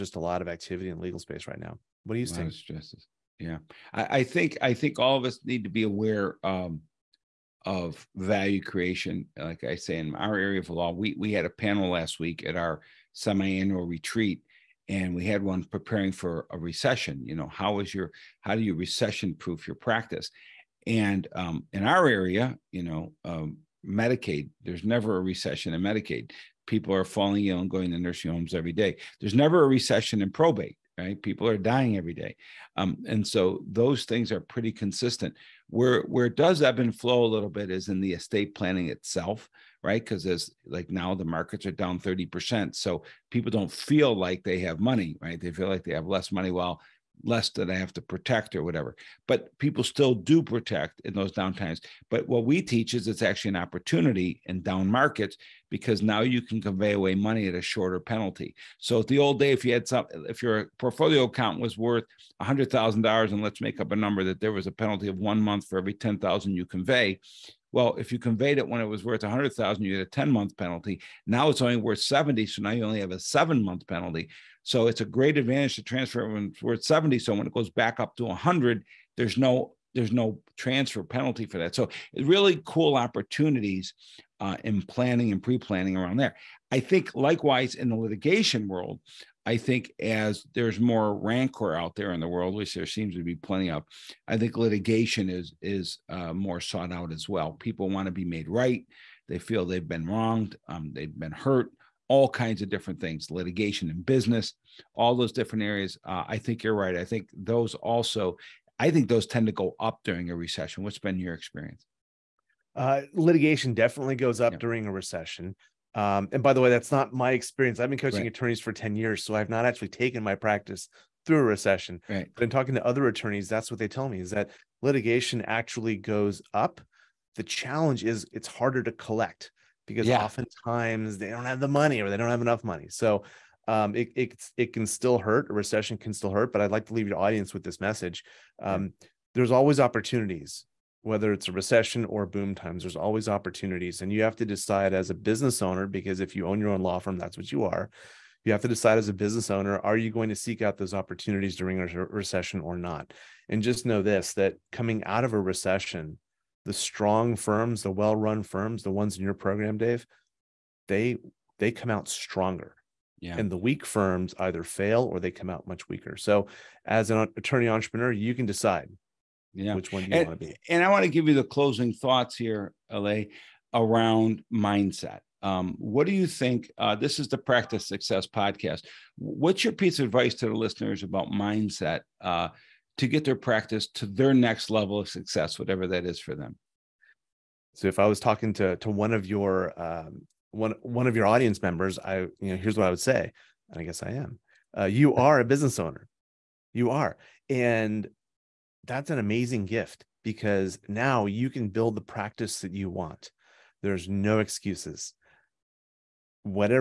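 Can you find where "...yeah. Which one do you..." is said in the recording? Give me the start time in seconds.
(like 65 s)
169 s.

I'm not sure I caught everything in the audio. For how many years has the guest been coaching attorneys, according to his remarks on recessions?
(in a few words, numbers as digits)
10 years.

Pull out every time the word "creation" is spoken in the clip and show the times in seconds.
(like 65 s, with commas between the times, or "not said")
8 s.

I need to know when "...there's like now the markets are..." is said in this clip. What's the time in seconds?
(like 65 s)
40 s.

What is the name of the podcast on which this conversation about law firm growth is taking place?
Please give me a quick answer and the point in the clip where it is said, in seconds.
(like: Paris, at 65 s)
Practice Success, at 177 s.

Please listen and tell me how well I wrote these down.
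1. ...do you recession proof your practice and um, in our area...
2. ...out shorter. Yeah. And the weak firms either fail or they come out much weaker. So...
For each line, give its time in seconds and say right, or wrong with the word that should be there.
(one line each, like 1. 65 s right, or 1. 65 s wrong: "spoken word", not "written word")
1. 18 s right
2. 161 s wrong: "stronger", not "shorter".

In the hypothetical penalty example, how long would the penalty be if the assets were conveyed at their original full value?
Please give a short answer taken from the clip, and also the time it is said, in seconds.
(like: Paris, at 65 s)
10 months, at 70 s.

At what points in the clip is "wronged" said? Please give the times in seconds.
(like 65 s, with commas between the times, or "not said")
100 s.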